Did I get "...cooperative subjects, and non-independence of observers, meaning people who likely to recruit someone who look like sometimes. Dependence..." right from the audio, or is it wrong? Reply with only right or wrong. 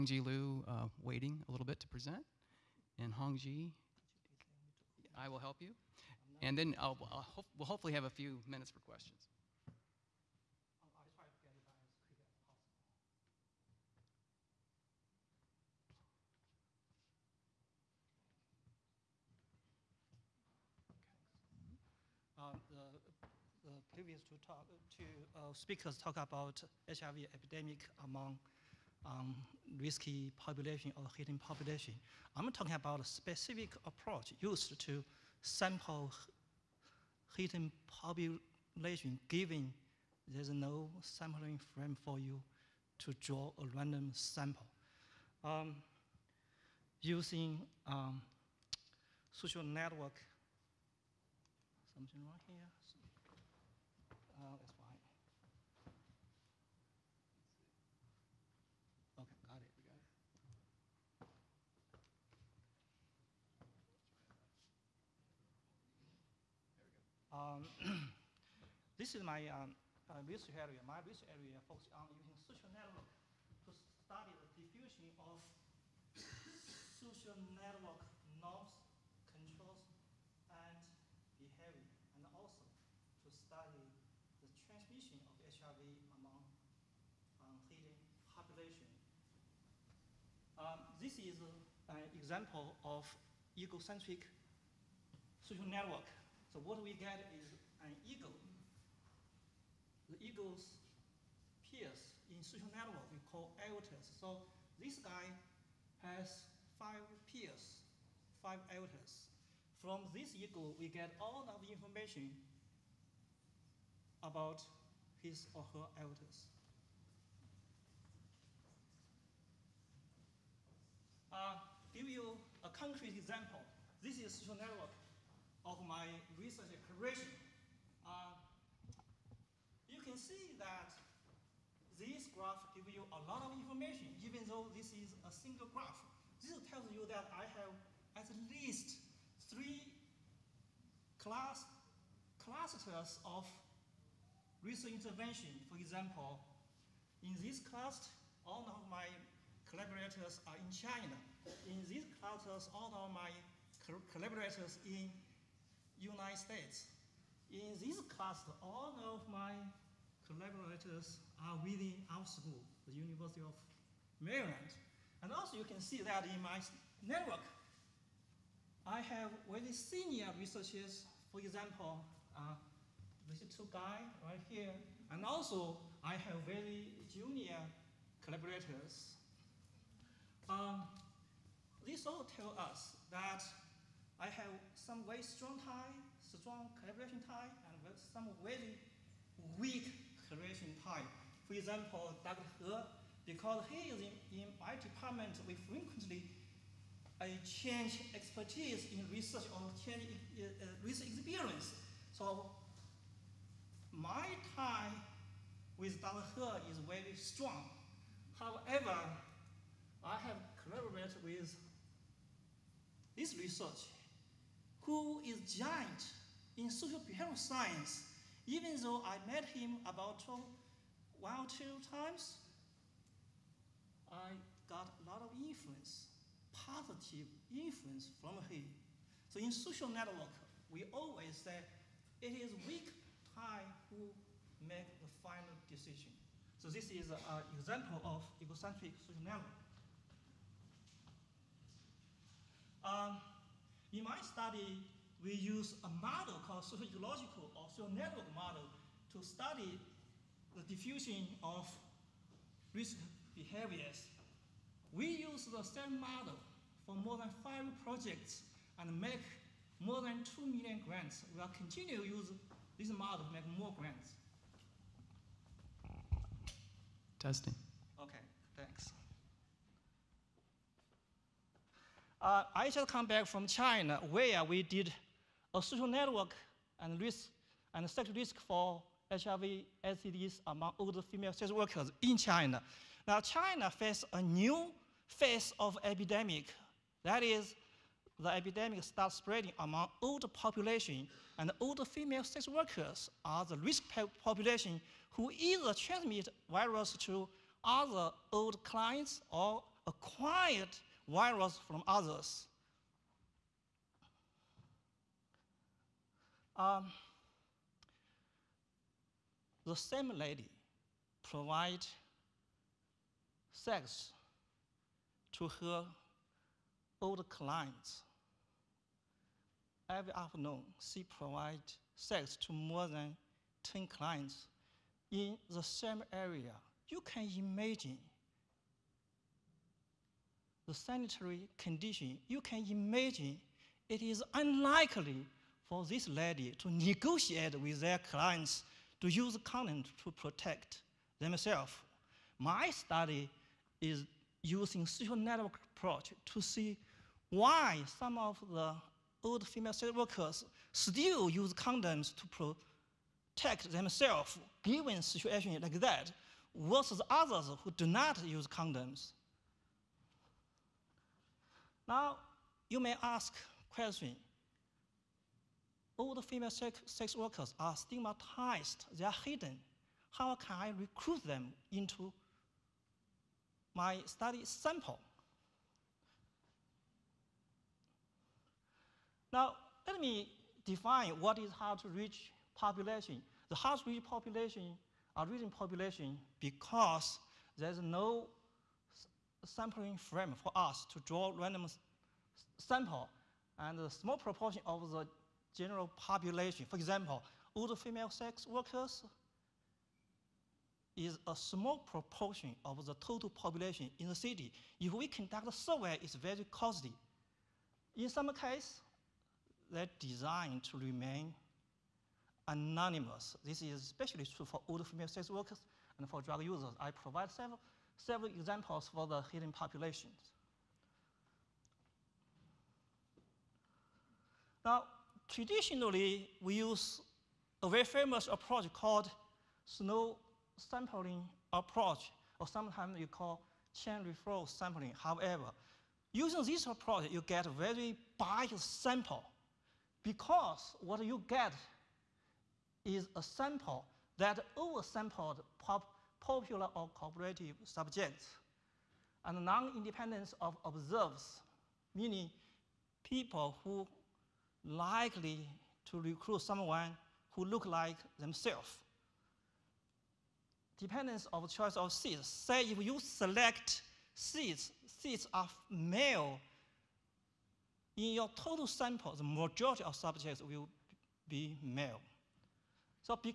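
wrong.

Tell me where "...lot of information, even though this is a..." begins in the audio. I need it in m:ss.
2:13.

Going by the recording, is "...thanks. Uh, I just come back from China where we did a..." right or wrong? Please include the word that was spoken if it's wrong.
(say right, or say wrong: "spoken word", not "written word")
right.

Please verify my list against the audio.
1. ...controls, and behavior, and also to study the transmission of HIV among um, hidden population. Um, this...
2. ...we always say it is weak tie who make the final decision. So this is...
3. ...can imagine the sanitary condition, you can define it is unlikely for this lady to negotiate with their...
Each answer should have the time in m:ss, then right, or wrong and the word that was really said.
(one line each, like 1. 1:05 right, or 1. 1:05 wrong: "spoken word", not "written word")
1. 1:19 right
2. 3:50 right
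3. 5:27 wrong: "imagine", not "define".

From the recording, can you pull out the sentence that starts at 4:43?
Now China faces a new phase of epidemic.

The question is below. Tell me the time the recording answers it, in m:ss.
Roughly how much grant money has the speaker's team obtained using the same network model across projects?
4:20.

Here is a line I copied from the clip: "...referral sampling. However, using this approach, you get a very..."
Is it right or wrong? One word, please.
right.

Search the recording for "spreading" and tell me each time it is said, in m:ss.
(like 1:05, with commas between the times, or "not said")
4:49.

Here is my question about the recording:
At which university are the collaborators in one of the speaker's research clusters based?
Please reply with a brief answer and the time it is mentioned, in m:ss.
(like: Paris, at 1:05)
University of Maryland, at 2:42.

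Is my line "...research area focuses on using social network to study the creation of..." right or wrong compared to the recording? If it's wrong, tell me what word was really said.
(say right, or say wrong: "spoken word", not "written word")
wrong: "diffusion", not "creation".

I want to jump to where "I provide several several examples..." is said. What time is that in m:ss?
6:56.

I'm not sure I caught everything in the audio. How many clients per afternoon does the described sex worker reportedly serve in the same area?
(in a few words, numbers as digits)
more than 10.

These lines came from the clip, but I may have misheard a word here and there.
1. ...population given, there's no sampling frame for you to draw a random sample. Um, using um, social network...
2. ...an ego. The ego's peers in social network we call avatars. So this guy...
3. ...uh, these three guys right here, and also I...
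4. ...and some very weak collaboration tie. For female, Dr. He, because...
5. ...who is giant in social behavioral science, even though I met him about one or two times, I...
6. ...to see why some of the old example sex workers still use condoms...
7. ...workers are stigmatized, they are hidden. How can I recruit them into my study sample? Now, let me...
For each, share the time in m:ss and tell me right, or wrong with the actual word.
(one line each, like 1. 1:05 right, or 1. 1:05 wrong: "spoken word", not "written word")
1. 0:37 right
2. 1:37 right
3. 2:52 wrong: "two", not "three"
4. 3:07 wrong: "example", not "female"
5. 3:34 right
6. 5:46 wrong: "female", not "example"
7. 6:07 right.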